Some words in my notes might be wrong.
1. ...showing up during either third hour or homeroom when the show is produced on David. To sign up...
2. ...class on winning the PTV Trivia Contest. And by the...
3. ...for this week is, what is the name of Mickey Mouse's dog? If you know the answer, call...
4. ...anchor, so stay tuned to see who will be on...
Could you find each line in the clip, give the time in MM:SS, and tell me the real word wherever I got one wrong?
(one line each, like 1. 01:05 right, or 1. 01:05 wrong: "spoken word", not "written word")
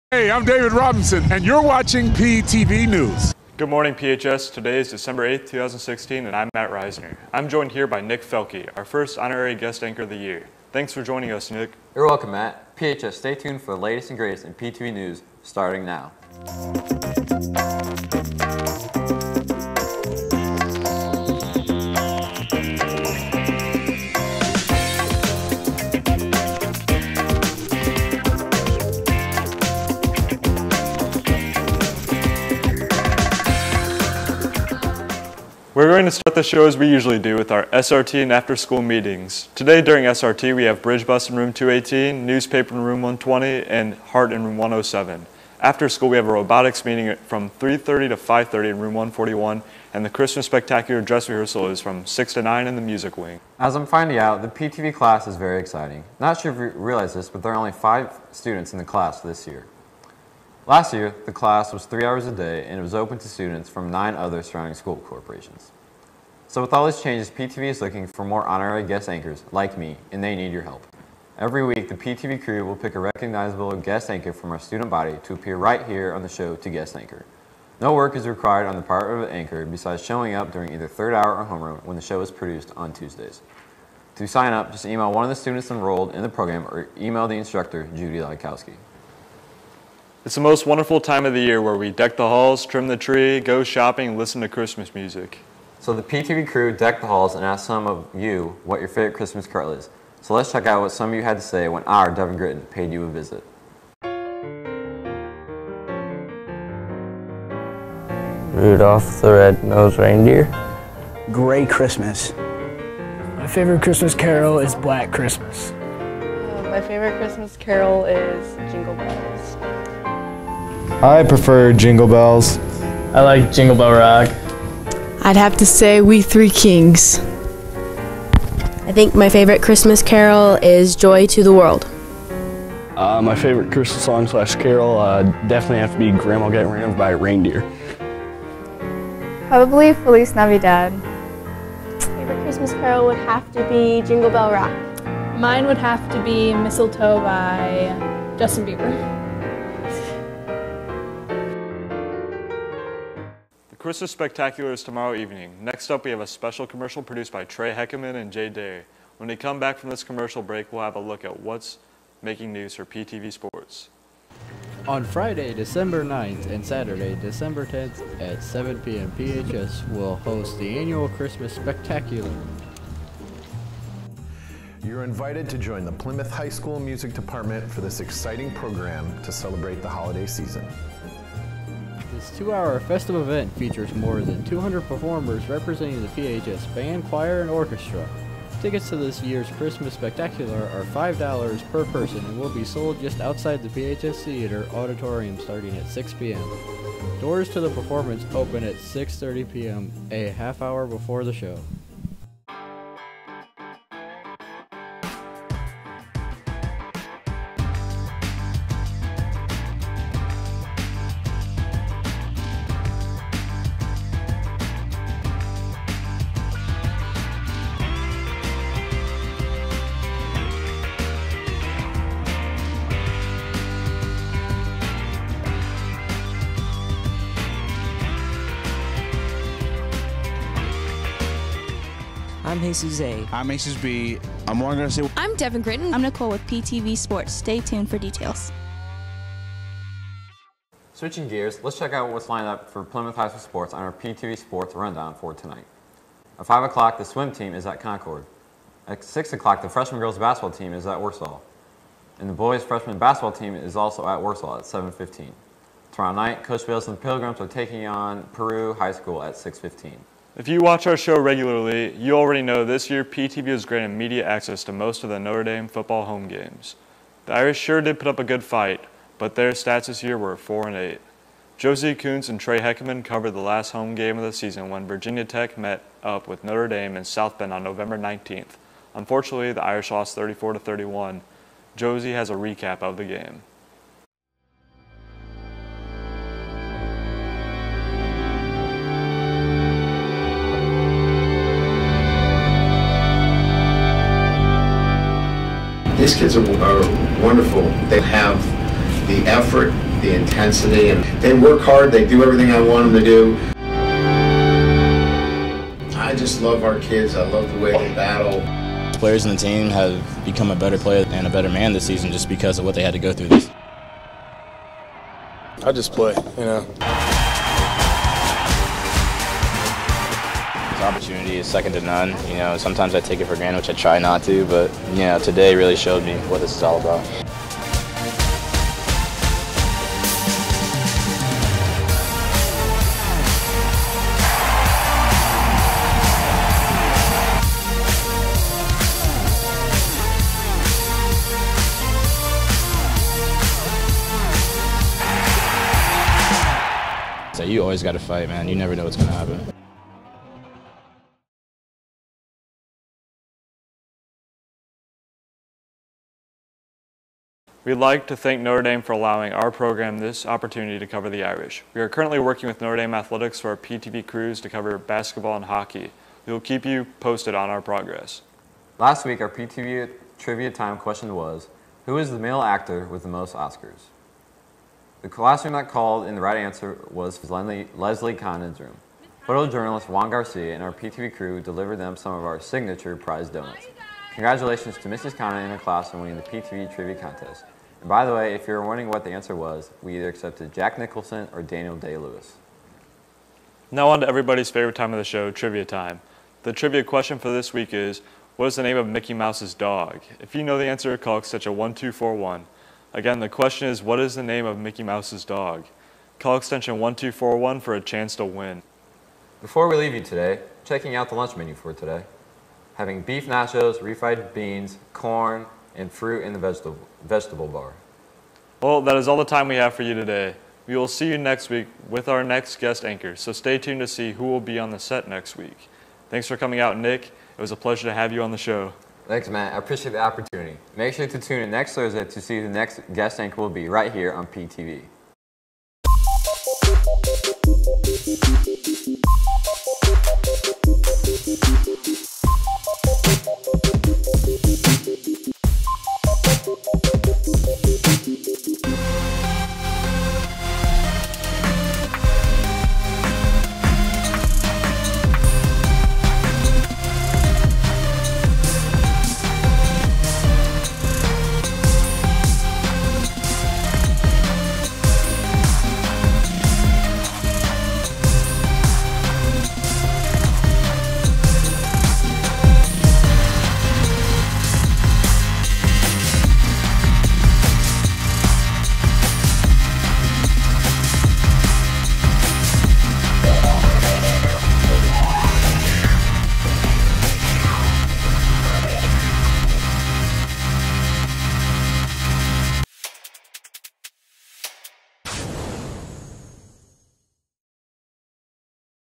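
1. 01:20 wrong: "Tuesdays", not "David"
2. 06:25 right
3. 06:37 right
4. 07:02 right.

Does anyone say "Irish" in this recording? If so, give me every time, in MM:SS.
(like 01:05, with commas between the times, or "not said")
04:27, 04:39, 06:01.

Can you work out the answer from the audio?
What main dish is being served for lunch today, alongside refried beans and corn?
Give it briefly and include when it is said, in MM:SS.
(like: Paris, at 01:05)
Beef nachos, at 06:53.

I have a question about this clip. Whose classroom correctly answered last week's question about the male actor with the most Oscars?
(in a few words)
Leslie Condon.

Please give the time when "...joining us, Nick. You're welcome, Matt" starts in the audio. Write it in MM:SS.
00:11.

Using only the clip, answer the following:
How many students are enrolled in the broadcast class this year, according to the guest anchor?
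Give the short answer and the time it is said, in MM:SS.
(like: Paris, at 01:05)
5, at 00:57.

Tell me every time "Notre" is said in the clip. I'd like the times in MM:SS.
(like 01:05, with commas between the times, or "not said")
04:25, 04:36, 05:58, 06:02.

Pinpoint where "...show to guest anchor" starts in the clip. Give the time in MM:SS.
01:16.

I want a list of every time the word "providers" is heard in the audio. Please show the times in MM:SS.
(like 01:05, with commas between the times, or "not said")
not said.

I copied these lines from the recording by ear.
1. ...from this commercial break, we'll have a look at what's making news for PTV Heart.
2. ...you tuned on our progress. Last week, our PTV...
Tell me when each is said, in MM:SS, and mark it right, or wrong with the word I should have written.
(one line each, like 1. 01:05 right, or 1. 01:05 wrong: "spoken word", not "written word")
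1. 02:39 wrong: "Sports", not "Heart"
2. 06:06 wrong: "posted", not "tuned".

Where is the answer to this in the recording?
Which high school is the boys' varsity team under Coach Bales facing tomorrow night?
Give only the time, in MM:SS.
04:18.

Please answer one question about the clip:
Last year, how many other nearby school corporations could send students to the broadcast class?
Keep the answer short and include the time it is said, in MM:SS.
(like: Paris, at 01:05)
9, at 01:03.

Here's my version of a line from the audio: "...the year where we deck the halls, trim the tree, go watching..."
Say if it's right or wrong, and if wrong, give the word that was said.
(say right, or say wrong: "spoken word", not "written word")
wrong: "shopping", not "watching".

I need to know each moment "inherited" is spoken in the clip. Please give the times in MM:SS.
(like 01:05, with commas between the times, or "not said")
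not said.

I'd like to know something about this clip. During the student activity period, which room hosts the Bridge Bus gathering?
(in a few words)
218.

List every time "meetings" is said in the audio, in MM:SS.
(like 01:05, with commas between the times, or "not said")
00:38, 00:46.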